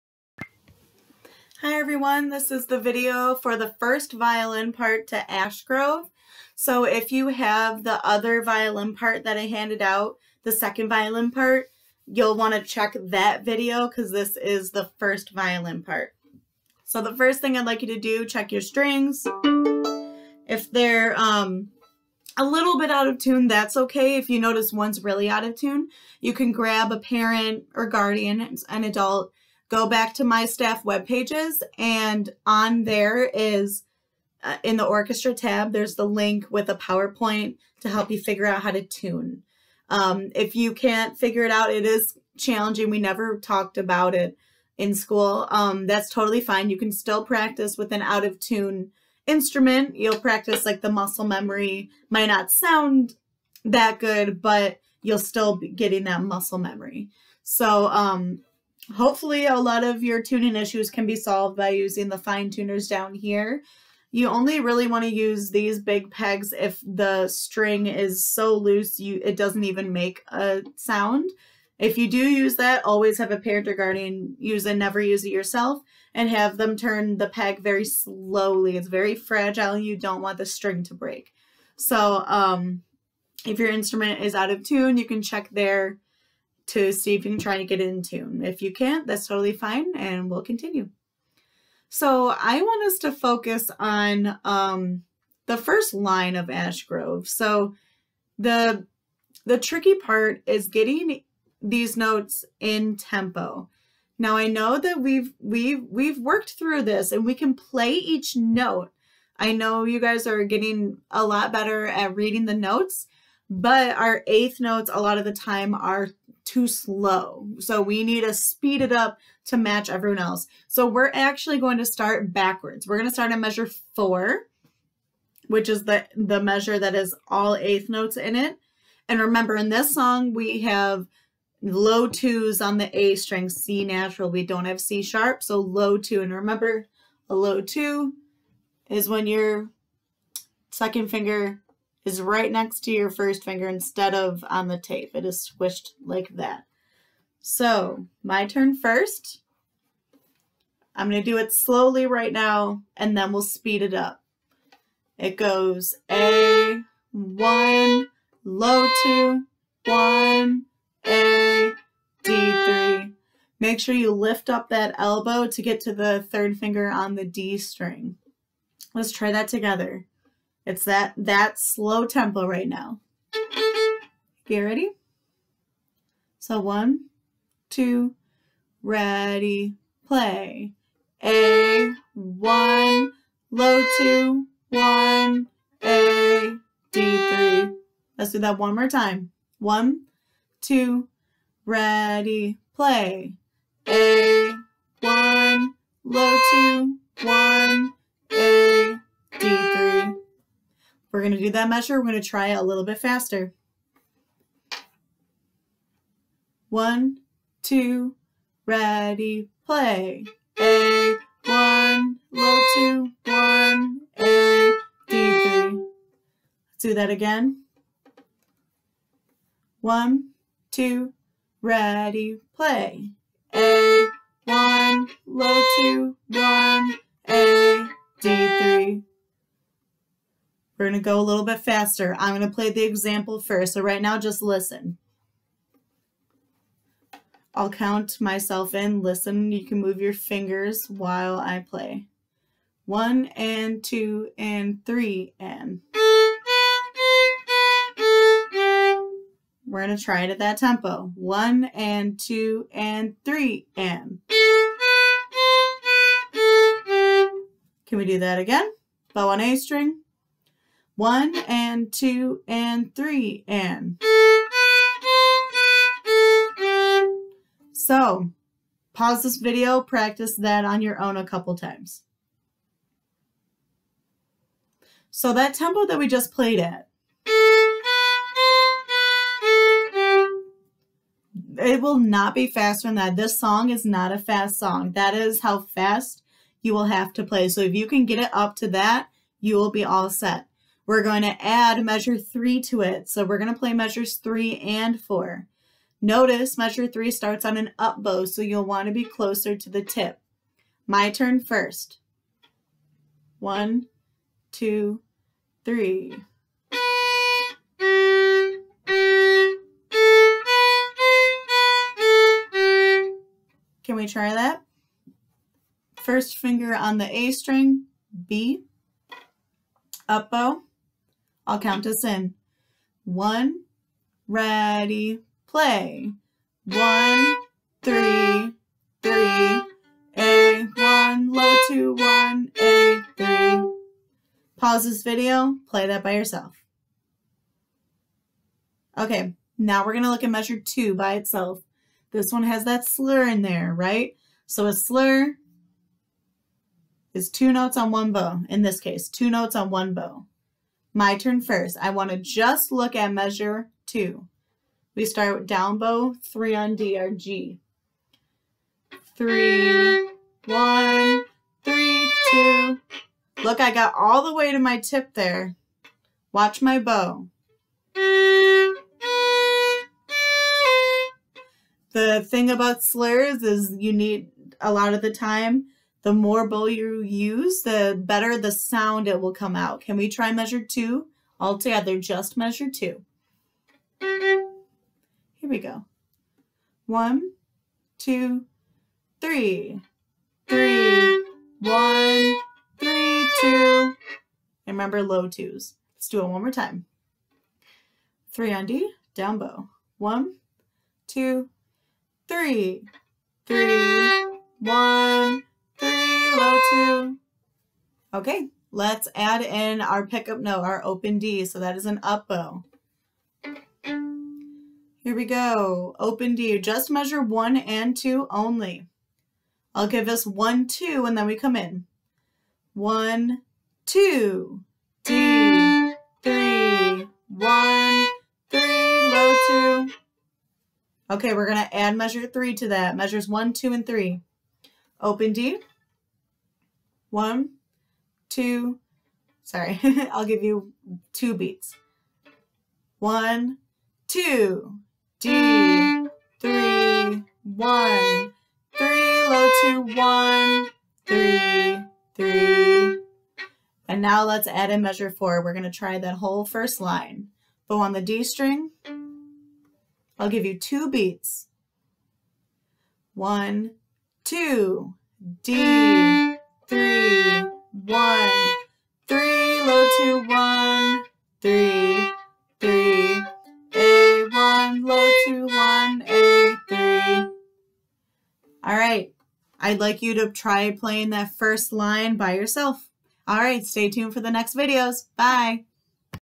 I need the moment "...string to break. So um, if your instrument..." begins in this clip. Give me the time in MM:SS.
01:20.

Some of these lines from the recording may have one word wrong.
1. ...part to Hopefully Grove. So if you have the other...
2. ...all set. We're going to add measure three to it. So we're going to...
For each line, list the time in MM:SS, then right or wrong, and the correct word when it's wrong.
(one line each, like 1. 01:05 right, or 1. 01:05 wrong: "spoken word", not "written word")
1. 00:04 wrong: "Ash", not "Hopefully"
2. 04:49 right.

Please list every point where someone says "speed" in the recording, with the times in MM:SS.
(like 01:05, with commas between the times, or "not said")
01:58, 02:33.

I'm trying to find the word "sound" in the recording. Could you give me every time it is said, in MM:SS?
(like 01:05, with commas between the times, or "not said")
00:52, 01:10, 06:18.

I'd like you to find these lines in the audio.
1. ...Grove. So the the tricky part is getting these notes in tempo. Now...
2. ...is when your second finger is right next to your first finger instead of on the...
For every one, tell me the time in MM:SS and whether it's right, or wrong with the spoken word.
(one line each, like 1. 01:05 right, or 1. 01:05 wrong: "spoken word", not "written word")
1. 01:36 right
2. 02:18 right.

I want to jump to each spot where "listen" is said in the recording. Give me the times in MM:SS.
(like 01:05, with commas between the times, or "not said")
03:54, 03:59.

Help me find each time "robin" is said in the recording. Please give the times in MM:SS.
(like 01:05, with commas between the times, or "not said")
not said.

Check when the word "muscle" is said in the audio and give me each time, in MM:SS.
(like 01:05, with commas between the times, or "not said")
00:50, 00:56.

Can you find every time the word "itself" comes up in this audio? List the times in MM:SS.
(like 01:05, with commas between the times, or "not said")
05:41.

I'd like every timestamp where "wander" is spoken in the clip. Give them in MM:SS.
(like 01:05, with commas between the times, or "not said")
not said.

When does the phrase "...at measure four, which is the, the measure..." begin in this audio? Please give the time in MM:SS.
02:03.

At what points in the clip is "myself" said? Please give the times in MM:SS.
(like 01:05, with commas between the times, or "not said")
03:58.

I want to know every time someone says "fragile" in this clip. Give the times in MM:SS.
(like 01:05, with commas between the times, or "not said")
01:19.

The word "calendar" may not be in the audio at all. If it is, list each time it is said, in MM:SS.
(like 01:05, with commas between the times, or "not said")
not said.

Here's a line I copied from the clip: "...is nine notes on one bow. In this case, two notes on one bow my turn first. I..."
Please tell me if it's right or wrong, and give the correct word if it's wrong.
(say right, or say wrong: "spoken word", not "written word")
wrong: "two", not "nine".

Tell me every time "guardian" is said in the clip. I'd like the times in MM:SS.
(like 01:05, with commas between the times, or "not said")
00:27, 01:13.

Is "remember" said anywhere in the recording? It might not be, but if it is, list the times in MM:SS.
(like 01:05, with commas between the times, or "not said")
02:09, 02:16, 06:34.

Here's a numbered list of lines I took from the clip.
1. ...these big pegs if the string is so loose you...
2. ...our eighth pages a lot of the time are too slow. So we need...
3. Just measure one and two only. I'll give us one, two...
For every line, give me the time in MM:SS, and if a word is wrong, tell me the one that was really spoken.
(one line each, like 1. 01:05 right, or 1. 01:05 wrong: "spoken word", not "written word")
1. 01:05 right
2. 01:53 wrong: "notes", not "pages"
3. 06:56 right.